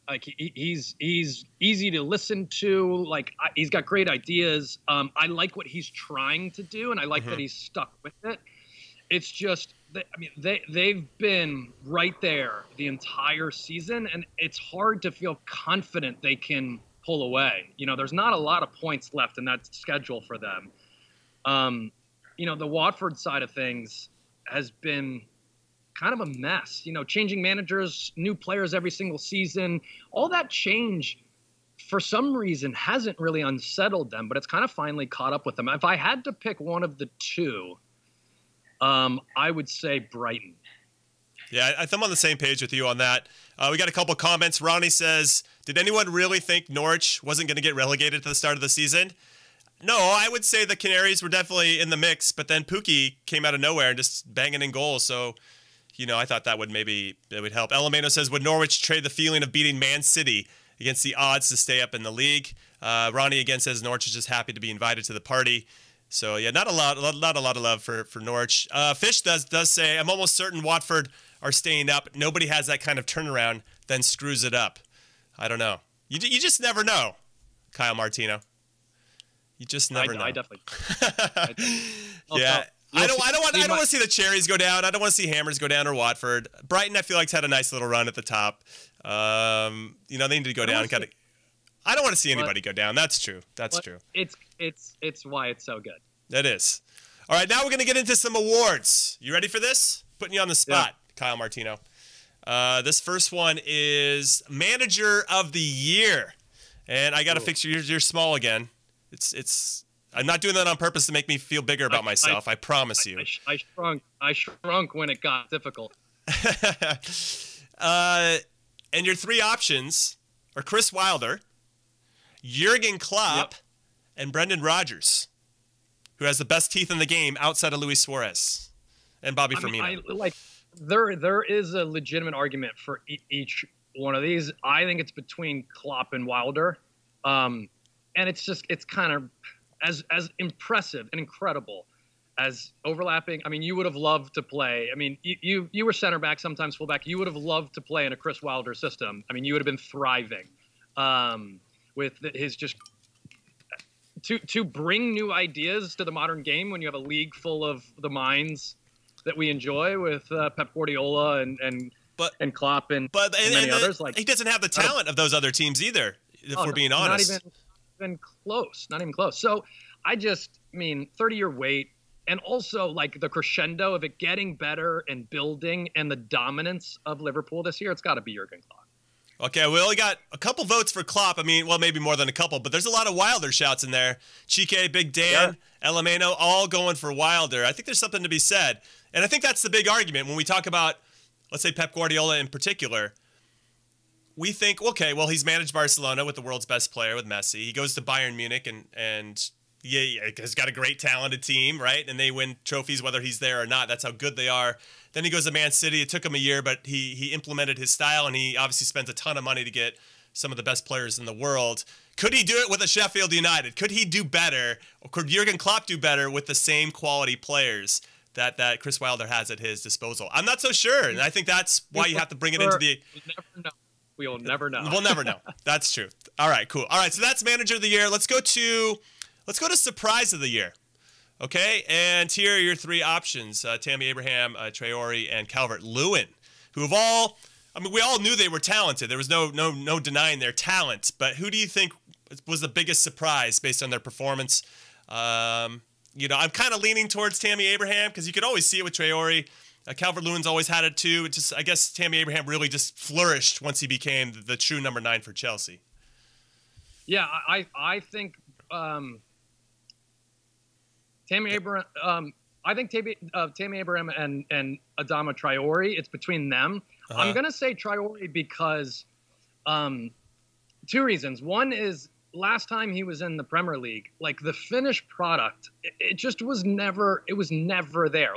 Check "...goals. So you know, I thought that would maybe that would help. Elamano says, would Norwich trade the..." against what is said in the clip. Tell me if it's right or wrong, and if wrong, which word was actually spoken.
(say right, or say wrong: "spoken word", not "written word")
right.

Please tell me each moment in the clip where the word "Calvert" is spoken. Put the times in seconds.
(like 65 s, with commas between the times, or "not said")
235 s, 249 s.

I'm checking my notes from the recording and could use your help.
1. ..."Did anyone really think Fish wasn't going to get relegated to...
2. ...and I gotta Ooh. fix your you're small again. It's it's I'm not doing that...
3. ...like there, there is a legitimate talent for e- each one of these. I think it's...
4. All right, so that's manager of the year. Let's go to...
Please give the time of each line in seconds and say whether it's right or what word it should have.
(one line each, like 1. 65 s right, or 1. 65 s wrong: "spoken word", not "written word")
1. 45 s wrong: "Norwich", not "Fish"
2. 106 s right
3. 130 s wrong: "argument", not "talent"
4. 226 s right.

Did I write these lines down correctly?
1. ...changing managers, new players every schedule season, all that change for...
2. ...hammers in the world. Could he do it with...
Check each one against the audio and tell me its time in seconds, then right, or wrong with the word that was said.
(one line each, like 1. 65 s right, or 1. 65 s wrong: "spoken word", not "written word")
1. 27 s wrong: "single", not "schedule"
2. 210 s wrong: "players", not "hammers".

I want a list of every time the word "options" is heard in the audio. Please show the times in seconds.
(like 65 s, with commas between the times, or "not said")
119 s, 232 s.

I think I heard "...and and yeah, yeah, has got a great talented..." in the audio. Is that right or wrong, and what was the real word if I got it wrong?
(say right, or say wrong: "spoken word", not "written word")
right.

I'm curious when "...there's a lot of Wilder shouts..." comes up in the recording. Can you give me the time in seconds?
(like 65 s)
182 s.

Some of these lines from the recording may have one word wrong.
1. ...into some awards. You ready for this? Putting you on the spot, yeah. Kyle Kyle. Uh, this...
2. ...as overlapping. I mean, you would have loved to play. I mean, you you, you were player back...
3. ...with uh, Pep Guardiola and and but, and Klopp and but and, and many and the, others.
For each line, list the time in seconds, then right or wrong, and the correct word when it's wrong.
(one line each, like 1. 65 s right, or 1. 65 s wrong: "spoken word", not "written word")
1. 97 s wrong: "Martino", not "Kyle"
2. 142 s wrong: "center", not "player"
3. 159 s right.